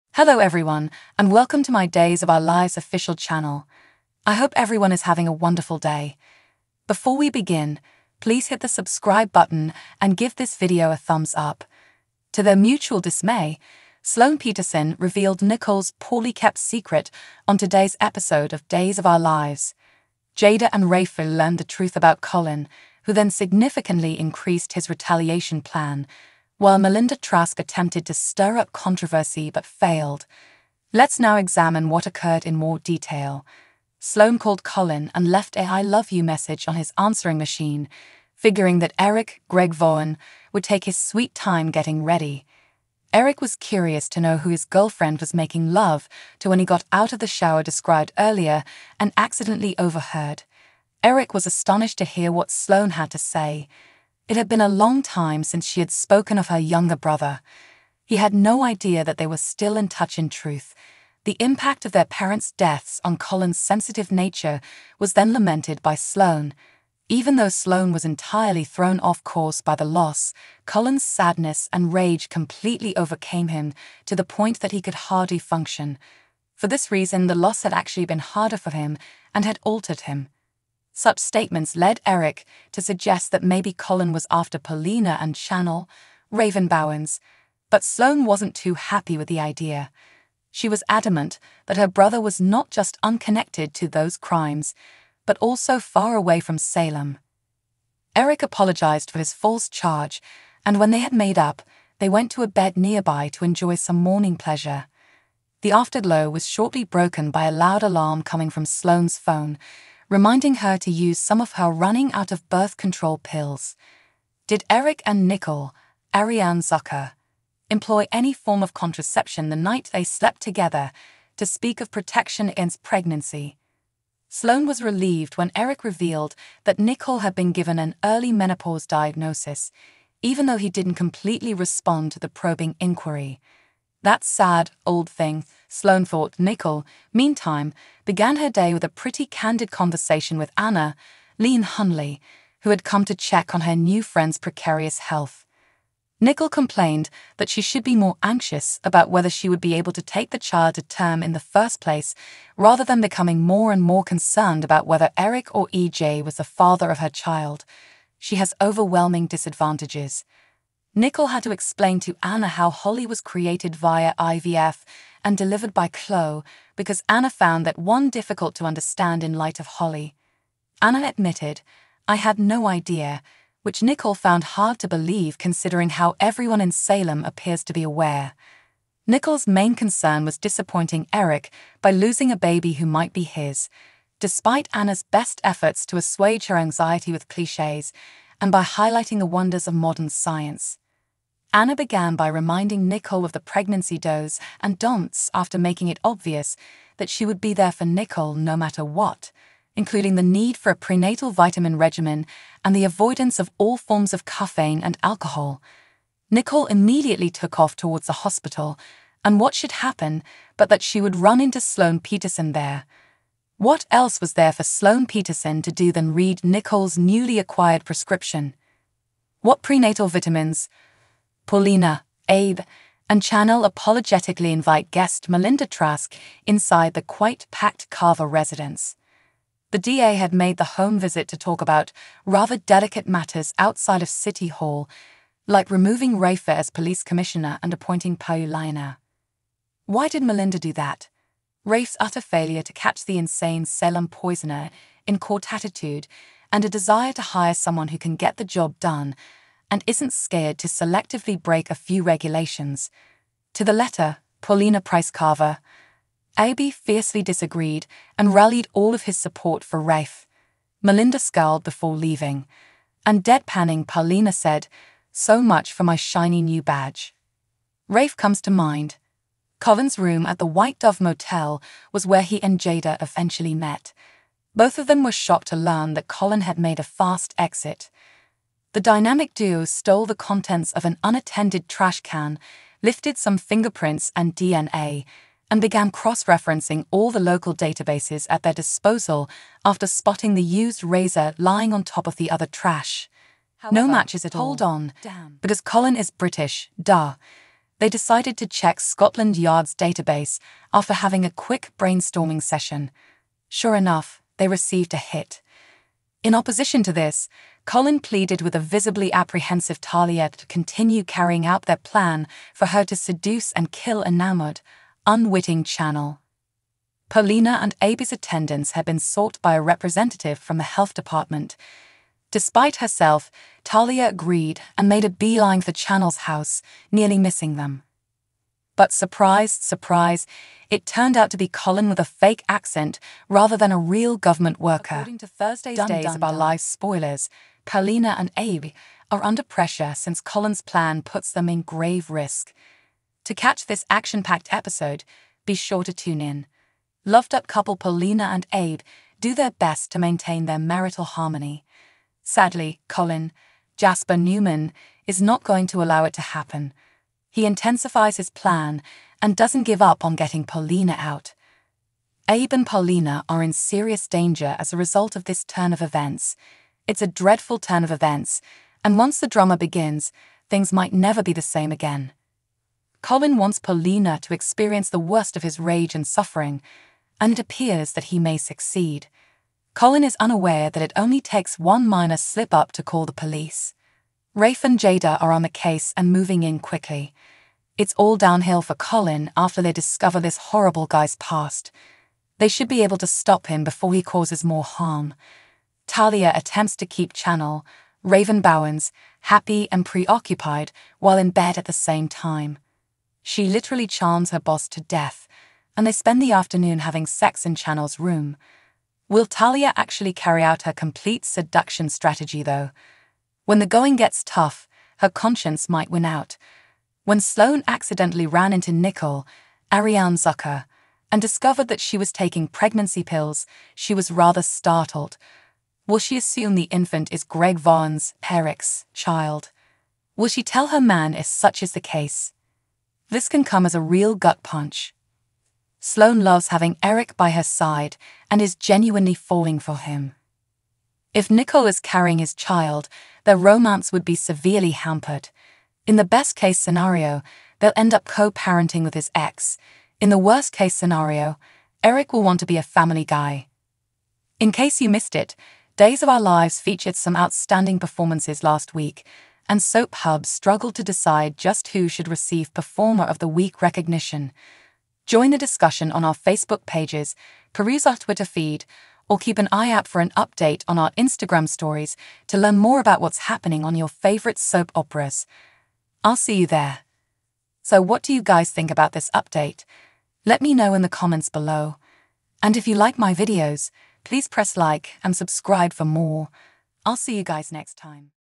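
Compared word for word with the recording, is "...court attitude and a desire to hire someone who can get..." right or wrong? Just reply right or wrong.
right.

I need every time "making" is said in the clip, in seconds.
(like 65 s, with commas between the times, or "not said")
45 s, 195 s.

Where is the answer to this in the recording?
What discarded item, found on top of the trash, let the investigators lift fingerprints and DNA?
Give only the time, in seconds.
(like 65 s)
290 s.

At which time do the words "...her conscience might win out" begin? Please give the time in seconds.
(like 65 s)
414 s.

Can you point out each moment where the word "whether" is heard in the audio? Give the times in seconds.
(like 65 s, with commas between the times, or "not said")
149 s, 154 s.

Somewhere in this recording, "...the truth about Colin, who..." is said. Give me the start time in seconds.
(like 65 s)
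21 s.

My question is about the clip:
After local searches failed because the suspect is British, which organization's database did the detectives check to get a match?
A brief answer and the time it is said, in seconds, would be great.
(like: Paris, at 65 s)
Scotland Yard, at 298 s.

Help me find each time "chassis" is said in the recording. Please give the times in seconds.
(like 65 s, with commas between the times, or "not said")
not said.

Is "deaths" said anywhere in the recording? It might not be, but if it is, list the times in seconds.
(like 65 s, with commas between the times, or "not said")
62 s, 404 s.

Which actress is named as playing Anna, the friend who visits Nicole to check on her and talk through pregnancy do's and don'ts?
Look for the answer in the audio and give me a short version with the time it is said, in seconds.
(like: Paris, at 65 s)
Leann Hunley, at 141 s.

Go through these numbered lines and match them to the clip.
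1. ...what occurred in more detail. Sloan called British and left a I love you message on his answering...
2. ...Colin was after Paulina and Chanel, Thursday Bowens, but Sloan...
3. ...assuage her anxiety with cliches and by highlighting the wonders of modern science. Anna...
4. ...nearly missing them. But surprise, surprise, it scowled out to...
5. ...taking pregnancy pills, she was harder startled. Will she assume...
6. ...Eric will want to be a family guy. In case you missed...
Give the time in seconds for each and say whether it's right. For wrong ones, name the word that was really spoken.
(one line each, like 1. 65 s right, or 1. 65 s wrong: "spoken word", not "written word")
1. 31 s wrong: "Colin", not "British"
2. 83 s wrong: "Raven", not "Thursday"
3. 185 s right
4. 326 s wrong: "turned", not "scowled"
5. 422 s wrong: "rather", not "harder"
6. 451 s right.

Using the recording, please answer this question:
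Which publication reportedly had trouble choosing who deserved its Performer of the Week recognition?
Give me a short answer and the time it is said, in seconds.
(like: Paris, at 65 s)
Soap Hub, at 459 s.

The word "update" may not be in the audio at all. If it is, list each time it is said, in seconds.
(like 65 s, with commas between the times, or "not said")
470 s, 479 s.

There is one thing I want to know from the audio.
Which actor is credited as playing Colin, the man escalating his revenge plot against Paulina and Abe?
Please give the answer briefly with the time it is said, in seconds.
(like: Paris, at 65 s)
Jasper Newman, at 353 s.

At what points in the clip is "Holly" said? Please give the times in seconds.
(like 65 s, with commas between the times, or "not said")
162 s, 169 s.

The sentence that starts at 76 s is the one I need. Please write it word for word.
For this reason, the loss had actually been harder for him and had altered him.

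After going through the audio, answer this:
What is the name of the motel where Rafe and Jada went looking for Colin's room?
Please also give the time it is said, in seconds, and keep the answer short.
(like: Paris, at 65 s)
White Dove Motel, at 270 s.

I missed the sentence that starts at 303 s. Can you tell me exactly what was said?
Sure enough, they received a hit.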